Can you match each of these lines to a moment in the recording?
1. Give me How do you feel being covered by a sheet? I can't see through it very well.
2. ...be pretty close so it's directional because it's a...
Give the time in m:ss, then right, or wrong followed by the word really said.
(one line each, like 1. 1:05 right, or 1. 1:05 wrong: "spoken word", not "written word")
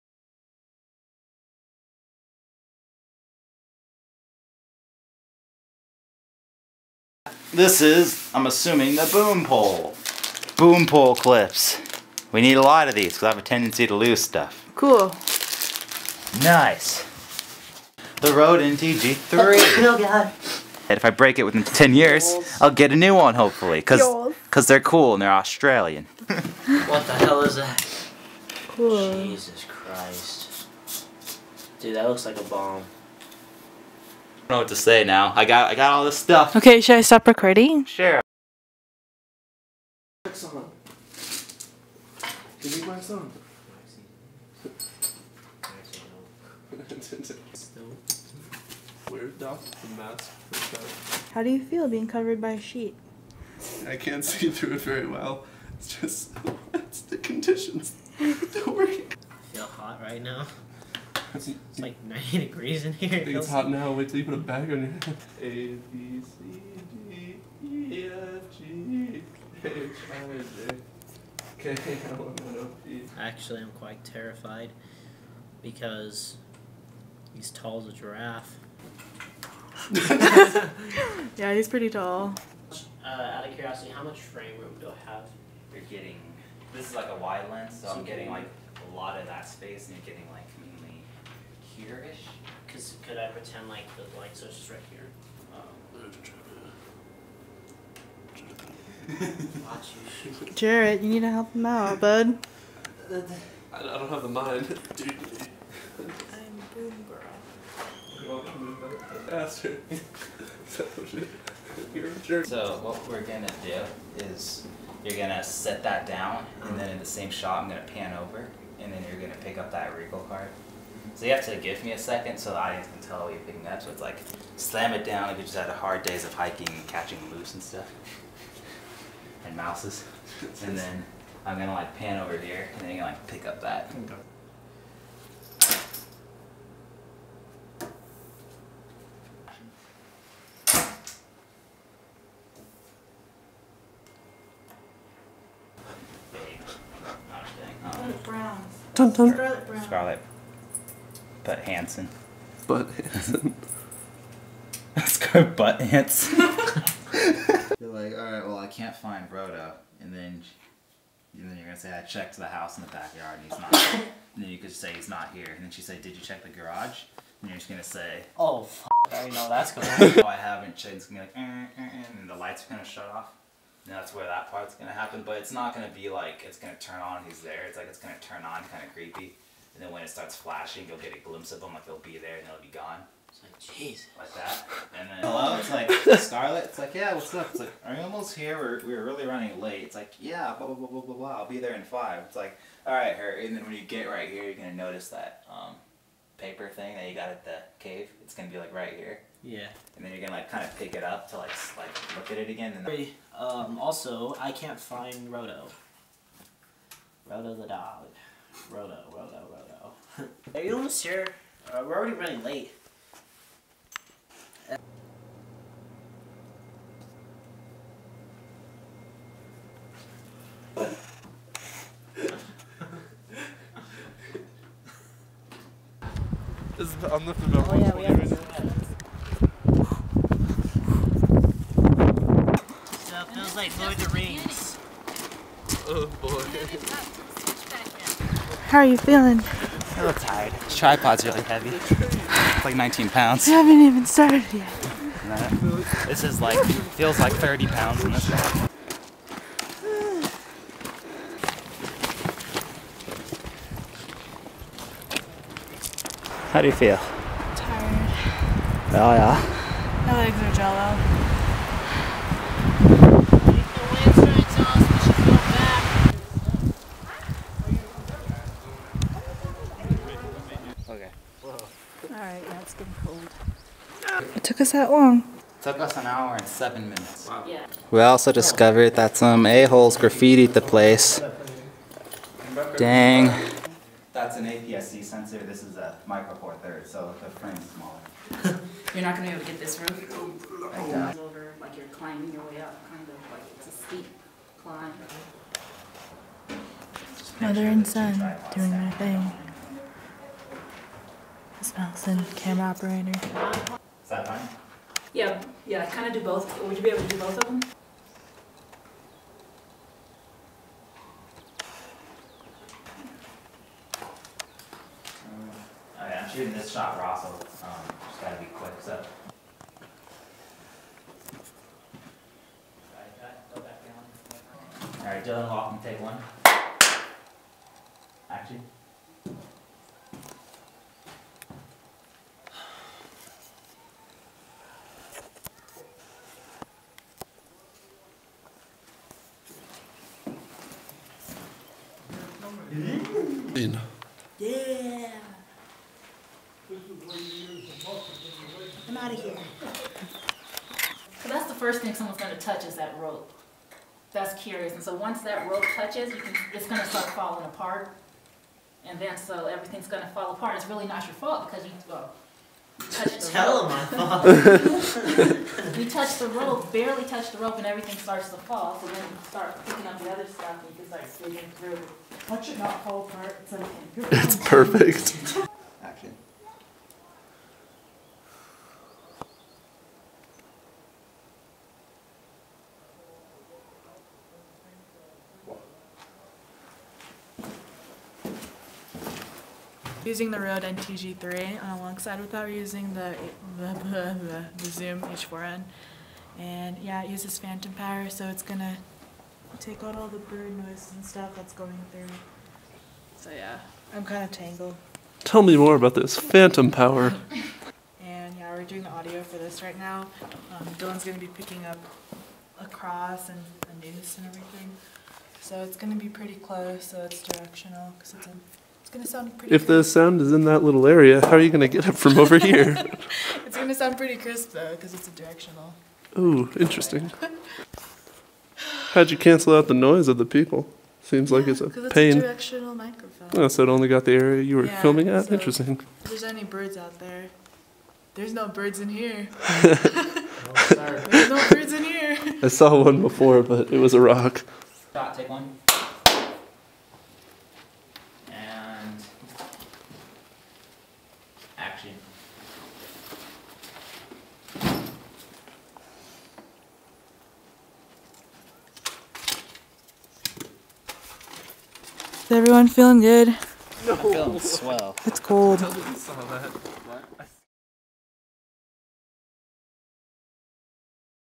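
1. 0:42 right
2. 6:55 right.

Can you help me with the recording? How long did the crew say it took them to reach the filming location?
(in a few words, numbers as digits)
an hour and seven minutes.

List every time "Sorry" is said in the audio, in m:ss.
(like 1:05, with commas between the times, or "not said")
7:20.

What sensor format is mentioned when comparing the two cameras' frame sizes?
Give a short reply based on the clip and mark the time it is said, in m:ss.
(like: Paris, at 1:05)
APS-C, at 4:44.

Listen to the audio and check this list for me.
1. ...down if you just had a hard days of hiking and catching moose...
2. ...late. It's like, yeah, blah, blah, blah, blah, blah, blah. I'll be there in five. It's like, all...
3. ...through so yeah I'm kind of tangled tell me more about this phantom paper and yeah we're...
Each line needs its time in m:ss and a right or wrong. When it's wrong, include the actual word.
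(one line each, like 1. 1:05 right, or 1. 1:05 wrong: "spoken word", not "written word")
1. 2:05 right
2. 3:09 right
3. 6:41 wrong: "power", not "paper".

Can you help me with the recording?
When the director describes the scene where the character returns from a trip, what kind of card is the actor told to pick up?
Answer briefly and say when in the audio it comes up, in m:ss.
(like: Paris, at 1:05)
regal card, at 1:59.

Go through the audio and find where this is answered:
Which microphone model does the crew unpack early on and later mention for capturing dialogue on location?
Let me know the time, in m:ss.
0:18.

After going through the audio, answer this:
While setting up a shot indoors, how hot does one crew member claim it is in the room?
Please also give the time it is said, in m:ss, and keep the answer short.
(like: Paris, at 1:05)
90 degrees, at 1:02.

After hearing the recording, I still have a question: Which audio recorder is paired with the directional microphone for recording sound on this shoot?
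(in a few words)
Zoom H4n.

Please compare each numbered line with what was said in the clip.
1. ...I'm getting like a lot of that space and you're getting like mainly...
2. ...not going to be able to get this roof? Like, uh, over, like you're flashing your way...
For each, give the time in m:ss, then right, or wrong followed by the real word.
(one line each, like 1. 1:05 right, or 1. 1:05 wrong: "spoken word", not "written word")
1. 1:27 right
2. 4:49 wrong: "climbing", not "flashing".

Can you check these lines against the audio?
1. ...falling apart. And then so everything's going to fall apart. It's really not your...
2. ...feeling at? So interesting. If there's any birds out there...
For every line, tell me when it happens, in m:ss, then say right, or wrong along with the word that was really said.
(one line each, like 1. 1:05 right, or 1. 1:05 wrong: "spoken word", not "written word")
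1. 5:57 right
2. 7:14 wrong: "filming", not "feeling".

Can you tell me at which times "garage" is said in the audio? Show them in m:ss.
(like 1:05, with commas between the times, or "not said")
2:46.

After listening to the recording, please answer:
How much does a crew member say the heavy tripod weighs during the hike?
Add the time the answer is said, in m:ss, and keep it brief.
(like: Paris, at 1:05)
19 pounds, at 4:02.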